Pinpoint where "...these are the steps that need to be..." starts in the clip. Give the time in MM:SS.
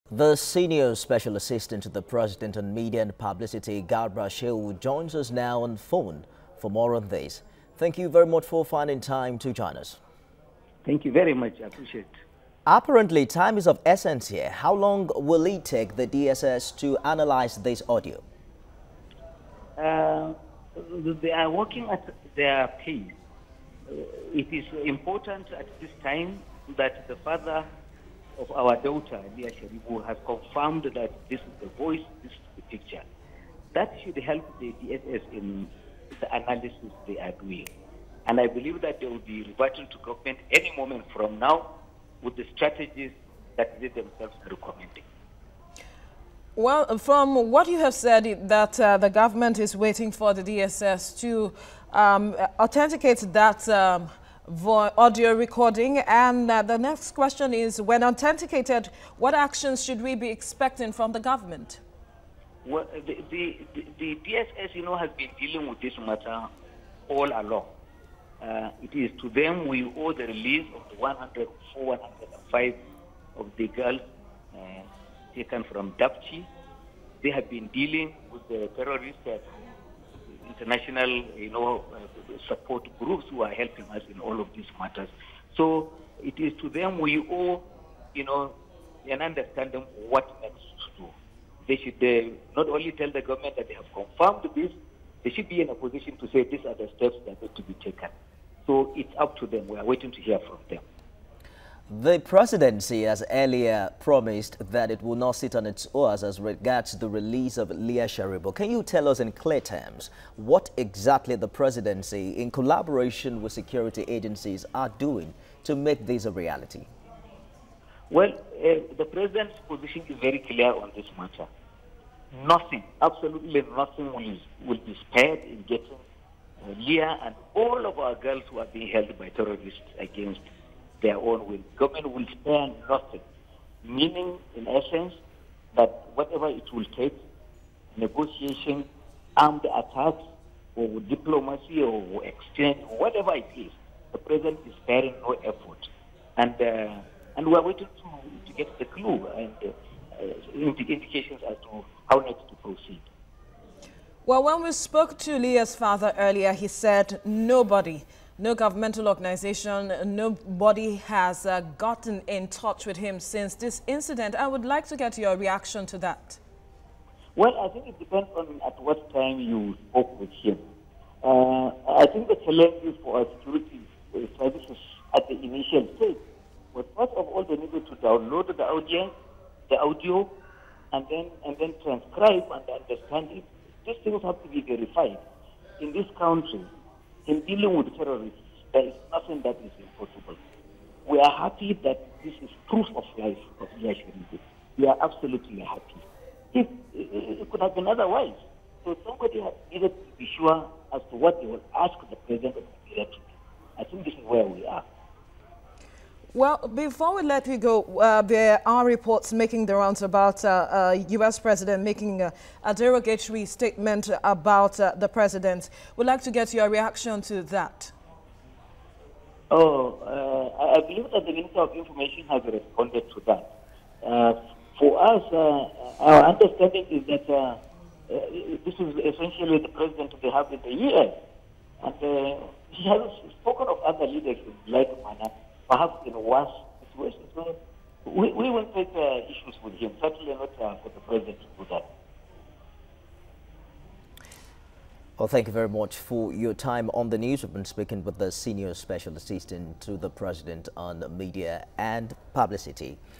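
01:36.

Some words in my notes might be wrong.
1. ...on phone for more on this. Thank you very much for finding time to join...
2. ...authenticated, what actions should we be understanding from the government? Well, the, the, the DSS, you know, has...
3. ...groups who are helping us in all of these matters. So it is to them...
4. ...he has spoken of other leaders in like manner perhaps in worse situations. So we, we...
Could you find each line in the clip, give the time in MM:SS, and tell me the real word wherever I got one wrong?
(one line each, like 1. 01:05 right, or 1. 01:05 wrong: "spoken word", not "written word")
1. 00:05 right
2. 00:58 wrong: "expecting", not "understanding"
3. 01:22 right
4. 03:52 right.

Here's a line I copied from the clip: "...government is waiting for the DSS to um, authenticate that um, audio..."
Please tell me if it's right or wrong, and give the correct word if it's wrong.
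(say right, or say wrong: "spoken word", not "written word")
right.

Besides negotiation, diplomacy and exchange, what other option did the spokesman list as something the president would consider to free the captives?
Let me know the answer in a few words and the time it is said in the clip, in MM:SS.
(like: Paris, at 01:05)
Armed attacks, at 02:19.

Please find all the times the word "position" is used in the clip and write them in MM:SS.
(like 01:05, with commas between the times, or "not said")
01:35, 01:59.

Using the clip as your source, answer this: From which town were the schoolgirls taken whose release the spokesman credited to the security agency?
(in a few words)
Dapchi.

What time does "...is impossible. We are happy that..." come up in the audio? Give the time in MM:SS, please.
03:09.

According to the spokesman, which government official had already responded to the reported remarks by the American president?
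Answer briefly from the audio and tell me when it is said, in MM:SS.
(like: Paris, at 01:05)
Minister of Information, at 03:41.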